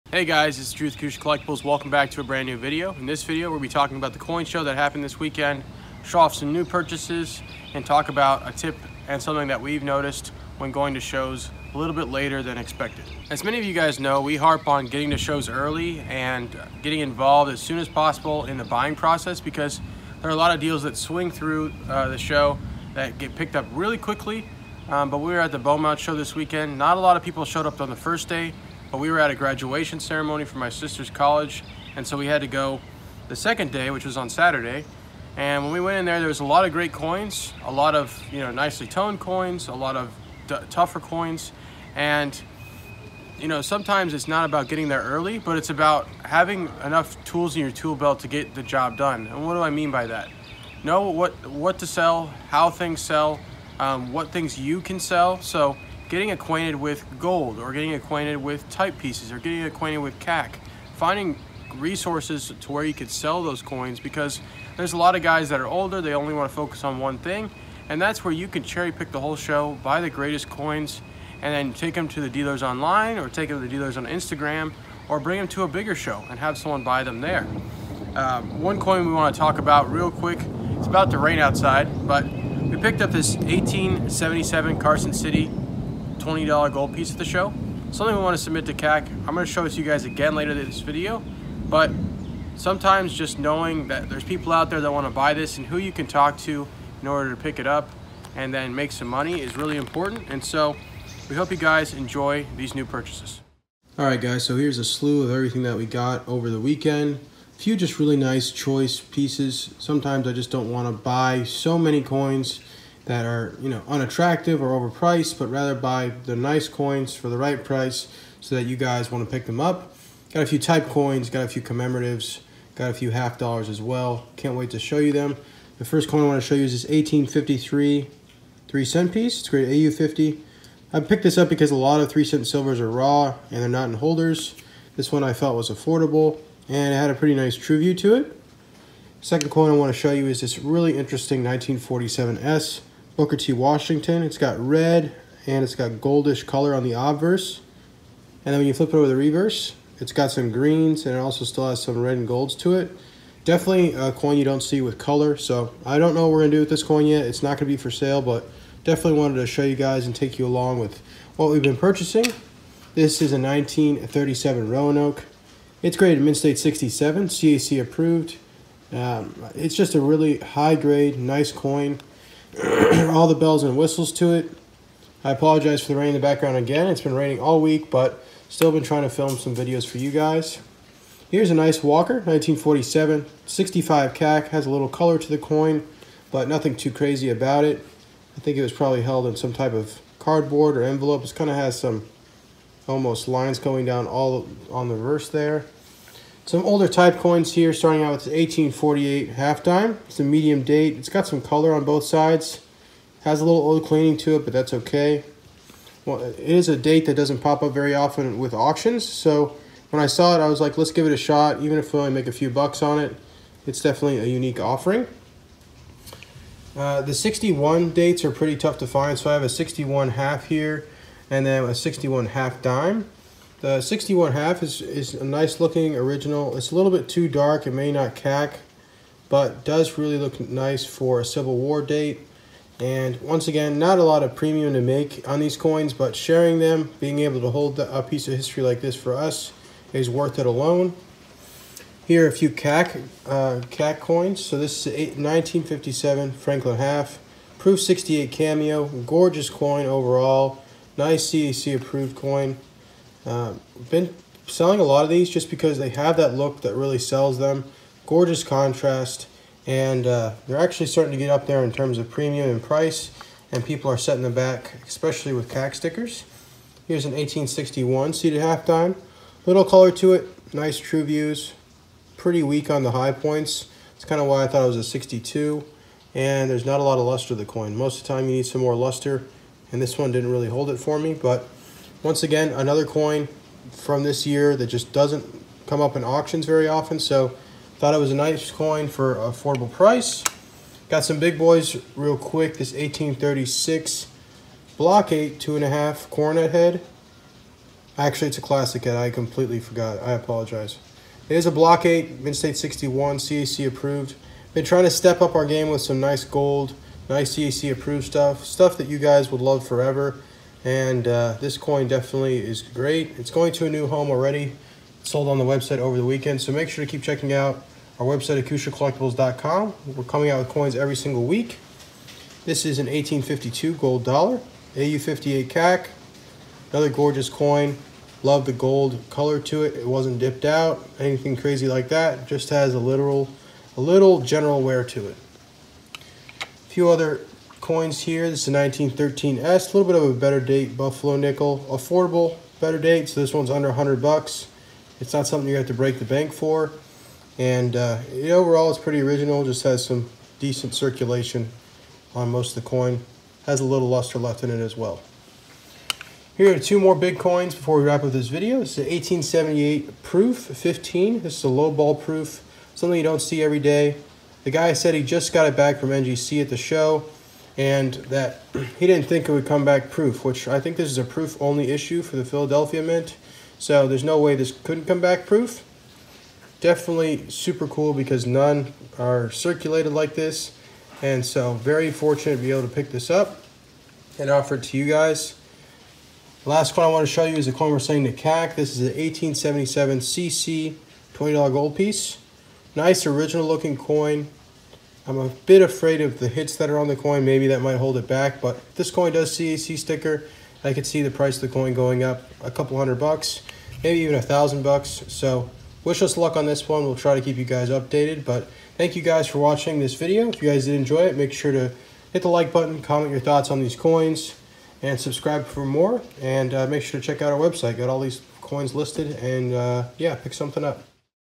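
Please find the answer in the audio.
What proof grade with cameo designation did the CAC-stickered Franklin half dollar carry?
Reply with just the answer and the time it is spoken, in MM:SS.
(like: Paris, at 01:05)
Proof 68 cameo, at 04:07.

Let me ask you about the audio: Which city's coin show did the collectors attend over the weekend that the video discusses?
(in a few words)
Beaumont.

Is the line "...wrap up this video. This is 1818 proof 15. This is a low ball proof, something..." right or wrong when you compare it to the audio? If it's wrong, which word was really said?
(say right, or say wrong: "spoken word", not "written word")
wrong: "1878", not "1818".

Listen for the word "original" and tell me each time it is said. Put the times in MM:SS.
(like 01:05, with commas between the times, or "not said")
03:45, 05:48, 06:33.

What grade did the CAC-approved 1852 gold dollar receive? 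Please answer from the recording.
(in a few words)
AU58.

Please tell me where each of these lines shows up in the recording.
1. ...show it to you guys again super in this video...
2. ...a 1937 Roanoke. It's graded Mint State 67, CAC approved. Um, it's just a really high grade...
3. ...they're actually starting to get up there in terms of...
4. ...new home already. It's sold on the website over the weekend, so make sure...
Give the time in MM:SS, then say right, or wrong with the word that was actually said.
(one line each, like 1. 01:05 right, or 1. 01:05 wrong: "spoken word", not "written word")
1. 01:29 wrong: "later", not "super"
2. 02:43 right
3. 04:20 right
4. 05:13 right.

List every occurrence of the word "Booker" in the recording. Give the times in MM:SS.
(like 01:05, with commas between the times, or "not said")
02:23.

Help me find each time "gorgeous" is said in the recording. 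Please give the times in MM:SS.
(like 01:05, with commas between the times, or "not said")
04:08, 04:18, 05:26.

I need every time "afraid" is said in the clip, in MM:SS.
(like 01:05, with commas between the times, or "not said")
06:35.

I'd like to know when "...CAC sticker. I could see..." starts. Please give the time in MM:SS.
06:39.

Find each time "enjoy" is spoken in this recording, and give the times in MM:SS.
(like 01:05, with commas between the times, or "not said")
01:41, 06:50.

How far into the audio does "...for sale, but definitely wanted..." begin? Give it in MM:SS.
02:37.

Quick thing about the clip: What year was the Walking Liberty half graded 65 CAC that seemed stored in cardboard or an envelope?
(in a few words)
1947.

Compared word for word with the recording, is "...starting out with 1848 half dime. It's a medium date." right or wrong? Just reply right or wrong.
right.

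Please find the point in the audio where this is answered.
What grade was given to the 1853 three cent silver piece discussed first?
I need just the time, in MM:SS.
02:09.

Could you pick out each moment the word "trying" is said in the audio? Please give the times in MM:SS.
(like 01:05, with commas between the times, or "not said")
02:58, 05:04.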